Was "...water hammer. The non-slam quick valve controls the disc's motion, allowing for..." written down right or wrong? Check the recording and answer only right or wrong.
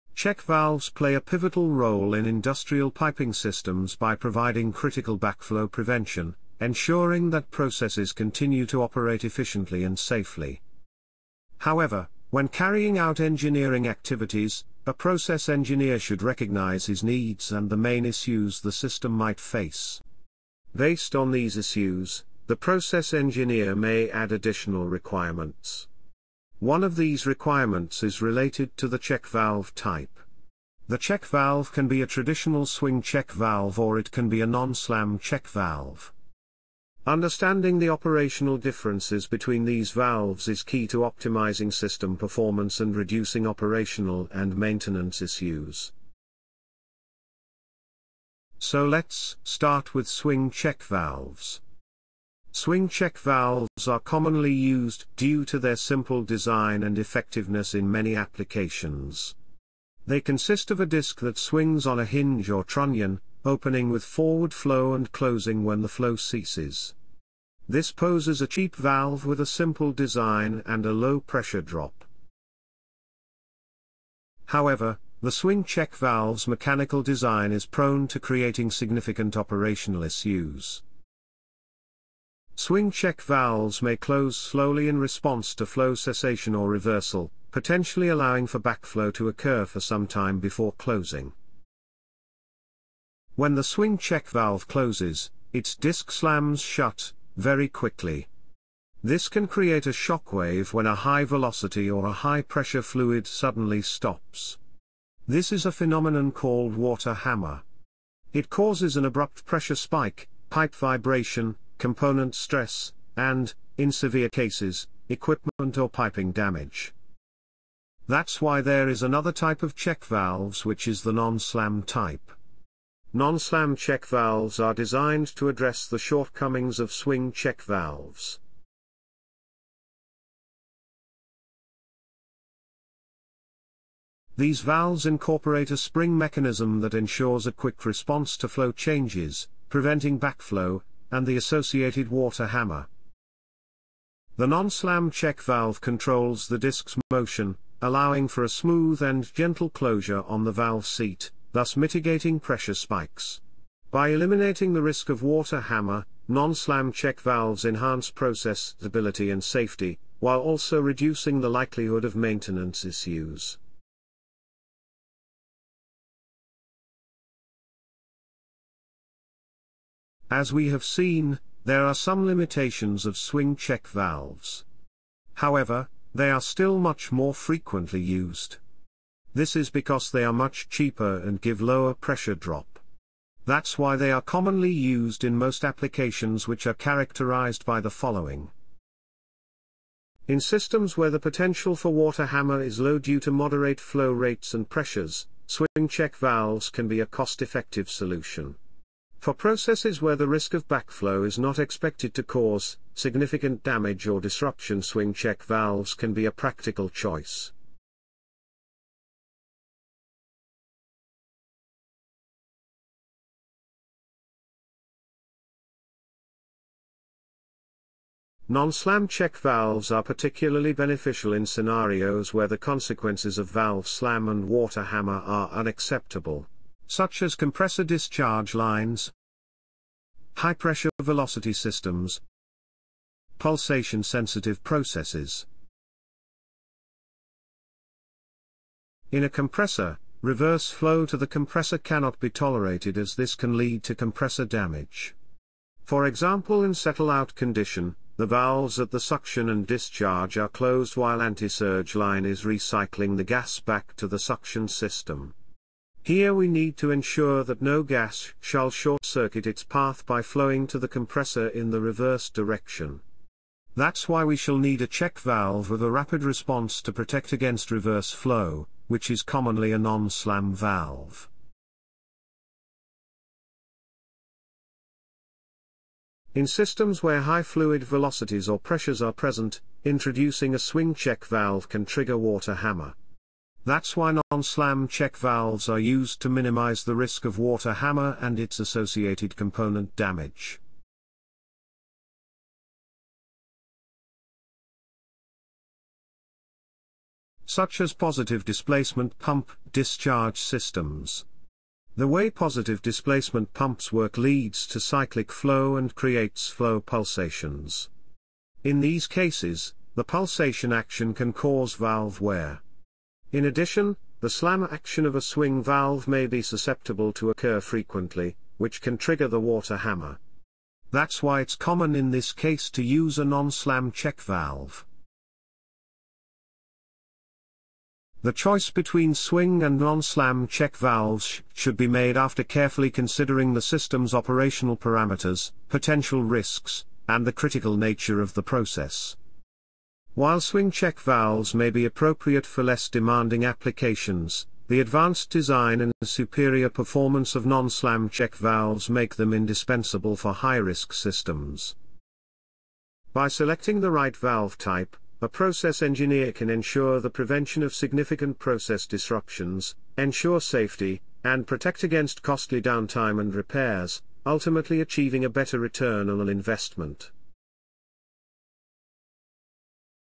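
wrong.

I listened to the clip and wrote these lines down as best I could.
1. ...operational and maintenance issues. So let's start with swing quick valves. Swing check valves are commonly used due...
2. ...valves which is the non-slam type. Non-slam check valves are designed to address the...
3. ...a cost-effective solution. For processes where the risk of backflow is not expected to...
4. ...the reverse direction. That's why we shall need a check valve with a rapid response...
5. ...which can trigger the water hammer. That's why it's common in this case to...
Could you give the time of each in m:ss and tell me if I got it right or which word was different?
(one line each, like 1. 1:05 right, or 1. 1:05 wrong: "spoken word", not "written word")
1. 0:43 wrong: "check", not "quick"
2. 2:00 right
3. 3:17 right
4. 4:21 right
5. 5:18 right.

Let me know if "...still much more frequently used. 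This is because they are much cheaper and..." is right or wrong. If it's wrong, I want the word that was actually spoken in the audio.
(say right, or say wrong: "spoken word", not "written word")
right.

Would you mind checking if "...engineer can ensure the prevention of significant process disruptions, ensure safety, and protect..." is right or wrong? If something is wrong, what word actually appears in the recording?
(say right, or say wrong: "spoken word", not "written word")
right.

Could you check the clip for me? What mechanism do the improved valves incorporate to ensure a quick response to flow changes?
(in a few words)
spring mechanism.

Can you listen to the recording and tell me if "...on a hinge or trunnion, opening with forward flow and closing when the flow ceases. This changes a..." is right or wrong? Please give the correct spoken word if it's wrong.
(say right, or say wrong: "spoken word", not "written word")
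wrong: "poses", not "changes".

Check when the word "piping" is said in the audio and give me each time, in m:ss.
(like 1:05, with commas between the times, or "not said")
0:02, 1:55.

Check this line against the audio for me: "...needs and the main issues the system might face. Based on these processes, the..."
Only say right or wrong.
wrong.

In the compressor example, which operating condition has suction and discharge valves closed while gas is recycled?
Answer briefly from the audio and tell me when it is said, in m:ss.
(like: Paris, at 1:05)
settle-out condition, at 4:06.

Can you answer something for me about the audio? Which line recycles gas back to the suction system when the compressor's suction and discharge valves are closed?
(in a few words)
anti-surge line.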